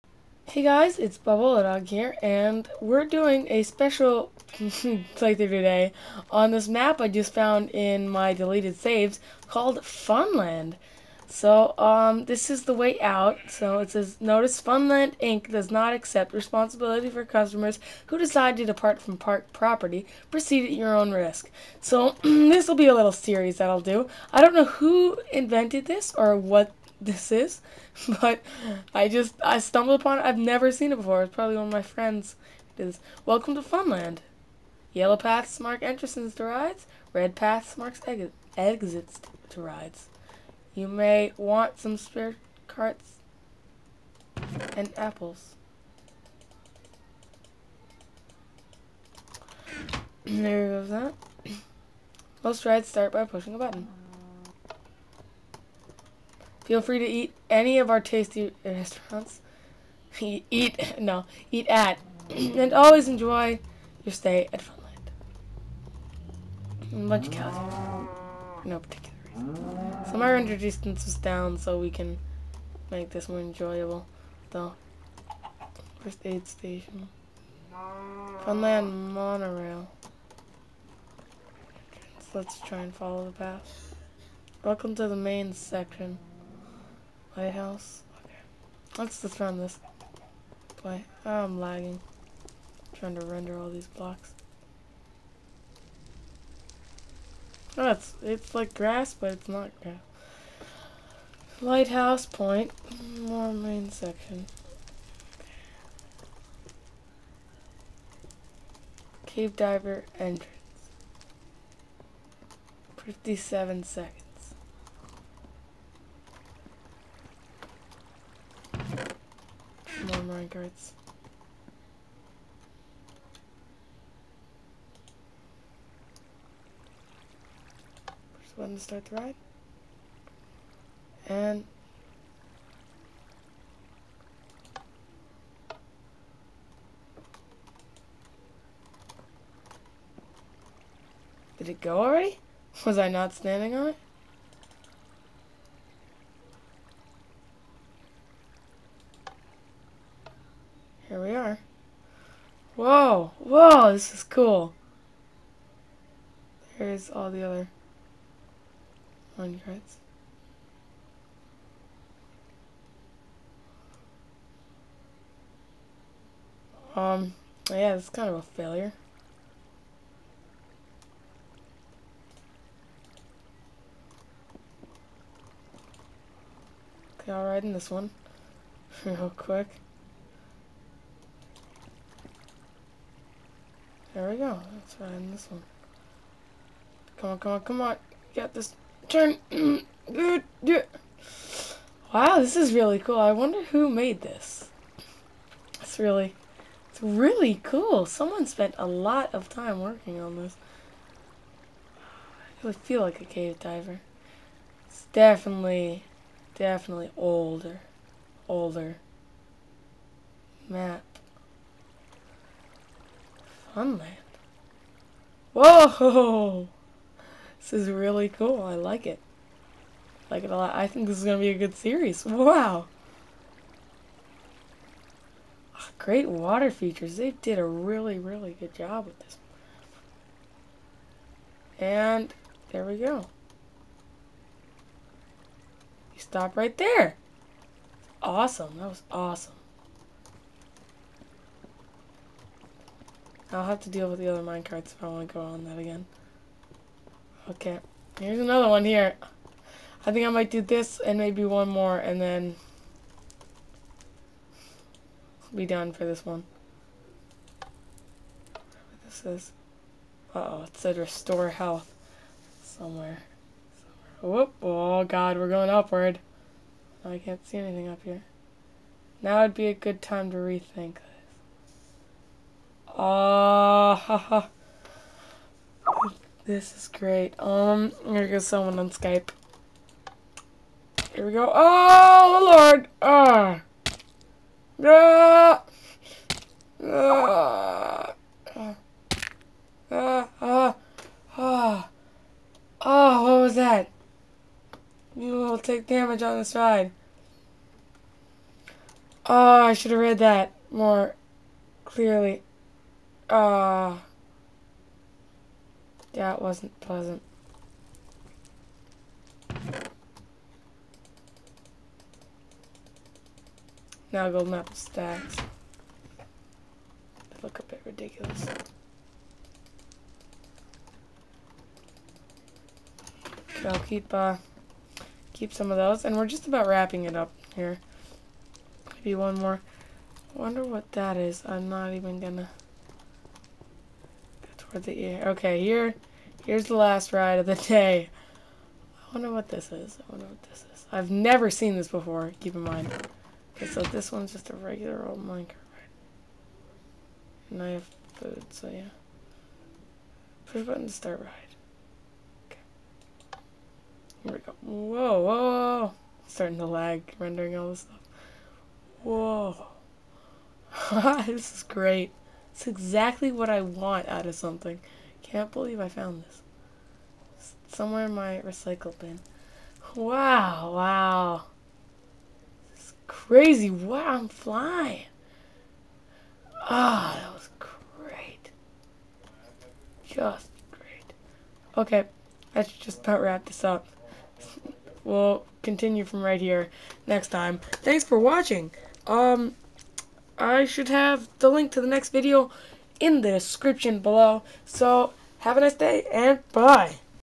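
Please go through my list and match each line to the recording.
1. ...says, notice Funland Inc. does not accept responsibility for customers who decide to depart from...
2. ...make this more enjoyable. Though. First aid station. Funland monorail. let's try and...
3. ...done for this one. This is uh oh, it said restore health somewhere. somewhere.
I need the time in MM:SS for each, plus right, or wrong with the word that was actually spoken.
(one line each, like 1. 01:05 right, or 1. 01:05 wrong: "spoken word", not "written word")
1. 00:13 right
2. 01:12 right
3. 04:15 right.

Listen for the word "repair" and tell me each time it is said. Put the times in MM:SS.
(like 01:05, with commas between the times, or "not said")
not said.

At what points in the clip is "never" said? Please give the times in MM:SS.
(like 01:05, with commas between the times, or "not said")
00:30, 05:41.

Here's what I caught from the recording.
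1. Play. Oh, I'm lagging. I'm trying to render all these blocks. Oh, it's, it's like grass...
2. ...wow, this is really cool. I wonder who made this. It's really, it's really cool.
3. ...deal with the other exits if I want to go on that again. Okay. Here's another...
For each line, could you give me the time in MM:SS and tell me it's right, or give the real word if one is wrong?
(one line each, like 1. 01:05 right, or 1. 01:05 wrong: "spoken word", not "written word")
1. 01:30 right
2. 03:12 right
3. 04:03 wrong: "minecarts", not "exits".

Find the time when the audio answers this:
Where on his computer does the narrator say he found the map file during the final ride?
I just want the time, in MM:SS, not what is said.
06:08.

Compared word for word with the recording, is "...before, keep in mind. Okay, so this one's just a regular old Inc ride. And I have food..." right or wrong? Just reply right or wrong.
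wrong.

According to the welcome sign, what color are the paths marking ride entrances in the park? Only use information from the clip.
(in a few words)
Yellow.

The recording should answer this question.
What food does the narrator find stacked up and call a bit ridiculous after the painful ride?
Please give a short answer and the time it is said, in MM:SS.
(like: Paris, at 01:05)
golden apple, at 05:14.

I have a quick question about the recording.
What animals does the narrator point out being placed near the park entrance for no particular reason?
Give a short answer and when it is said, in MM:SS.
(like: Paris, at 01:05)
cows, at 01:07.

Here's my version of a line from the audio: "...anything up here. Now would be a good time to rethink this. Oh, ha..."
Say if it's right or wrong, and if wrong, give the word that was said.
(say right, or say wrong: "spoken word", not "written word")
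right.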